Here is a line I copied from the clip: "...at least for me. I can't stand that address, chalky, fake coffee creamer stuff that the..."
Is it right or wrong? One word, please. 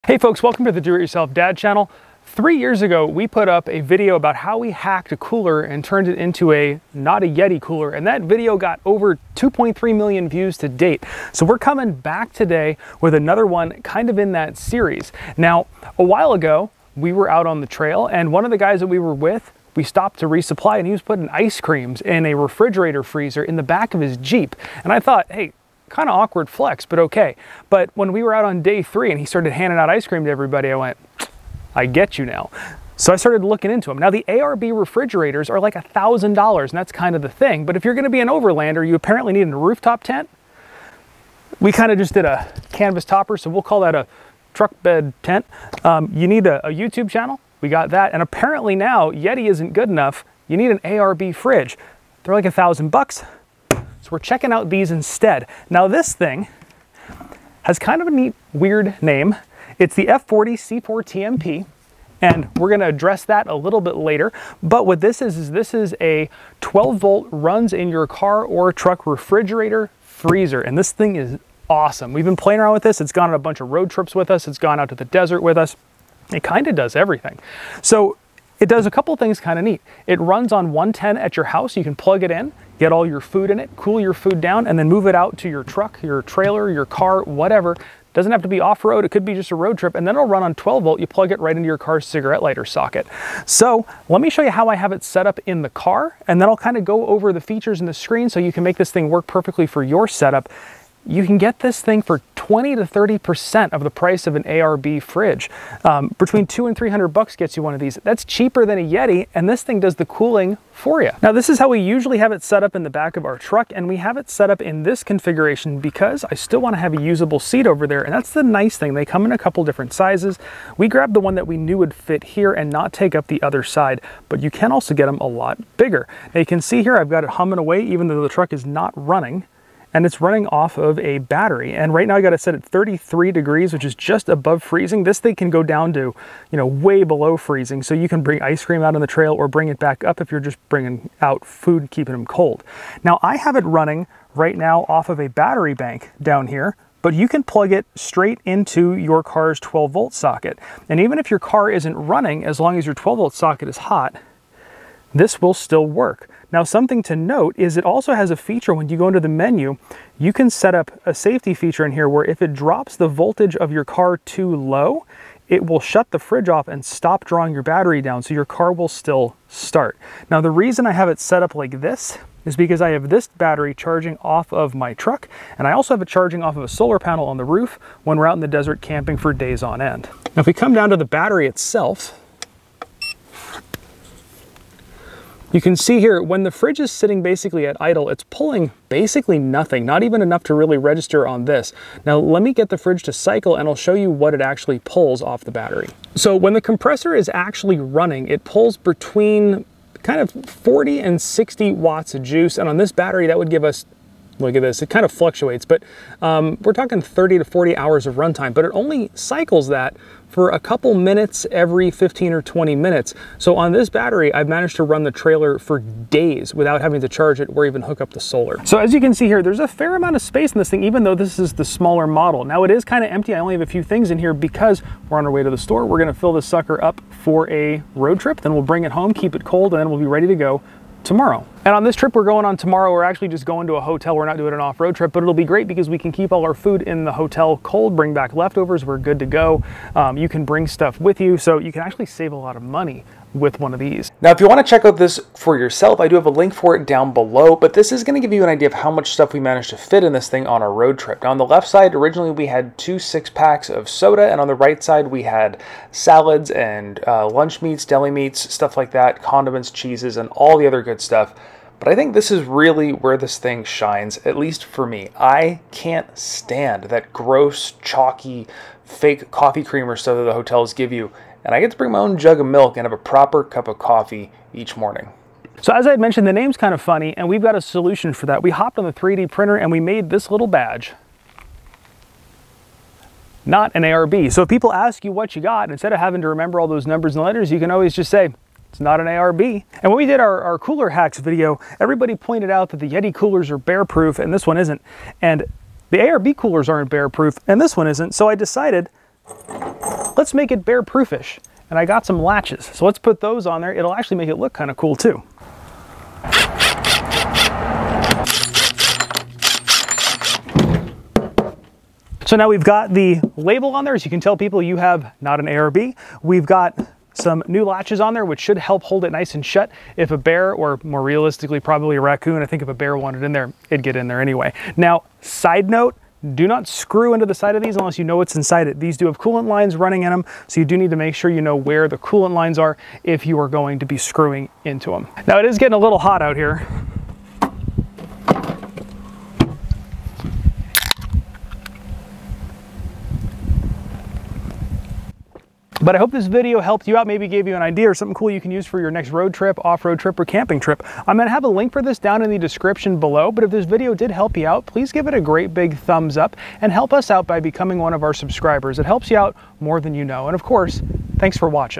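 wrong.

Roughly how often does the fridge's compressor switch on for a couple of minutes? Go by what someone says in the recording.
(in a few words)
every 15 or 20 minutes.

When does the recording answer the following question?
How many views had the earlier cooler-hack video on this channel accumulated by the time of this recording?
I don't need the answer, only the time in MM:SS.
00:09.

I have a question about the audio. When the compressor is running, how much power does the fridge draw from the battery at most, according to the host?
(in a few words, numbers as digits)
60 watts.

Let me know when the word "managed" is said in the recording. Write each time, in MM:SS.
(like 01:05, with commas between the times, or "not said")
03:34, 04:09.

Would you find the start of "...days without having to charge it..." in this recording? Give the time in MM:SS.
03:35.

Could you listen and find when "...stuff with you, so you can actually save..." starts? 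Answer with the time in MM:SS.
04:00.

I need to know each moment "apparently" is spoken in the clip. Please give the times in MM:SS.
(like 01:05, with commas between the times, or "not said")
00:38, 00:48.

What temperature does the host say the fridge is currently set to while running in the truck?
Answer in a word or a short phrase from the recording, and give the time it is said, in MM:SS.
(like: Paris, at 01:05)
33 degrees, at 02:12.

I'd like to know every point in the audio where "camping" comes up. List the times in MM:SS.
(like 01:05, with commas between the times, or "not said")
02:58, 05:50.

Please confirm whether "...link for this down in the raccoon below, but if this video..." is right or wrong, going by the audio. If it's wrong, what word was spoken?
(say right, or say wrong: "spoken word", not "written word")
wrong: "description", not "raccoon".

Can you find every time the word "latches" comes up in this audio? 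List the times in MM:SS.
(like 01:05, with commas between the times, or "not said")
05:02, 05:17.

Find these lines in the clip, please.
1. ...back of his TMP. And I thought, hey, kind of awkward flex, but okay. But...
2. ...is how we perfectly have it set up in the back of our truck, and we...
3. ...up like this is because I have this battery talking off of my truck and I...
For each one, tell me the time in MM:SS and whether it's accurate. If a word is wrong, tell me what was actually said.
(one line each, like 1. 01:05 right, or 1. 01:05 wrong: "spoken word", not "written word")
1. 00:23 wrong: "Jeep", not "TMP"
2. 01:51 wrong: "usually", not "perfectly"
3. 02:51 wrong: "charging", not "talking".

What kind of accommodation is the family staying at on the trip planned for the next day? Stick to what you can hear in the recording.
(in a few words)
a hotel.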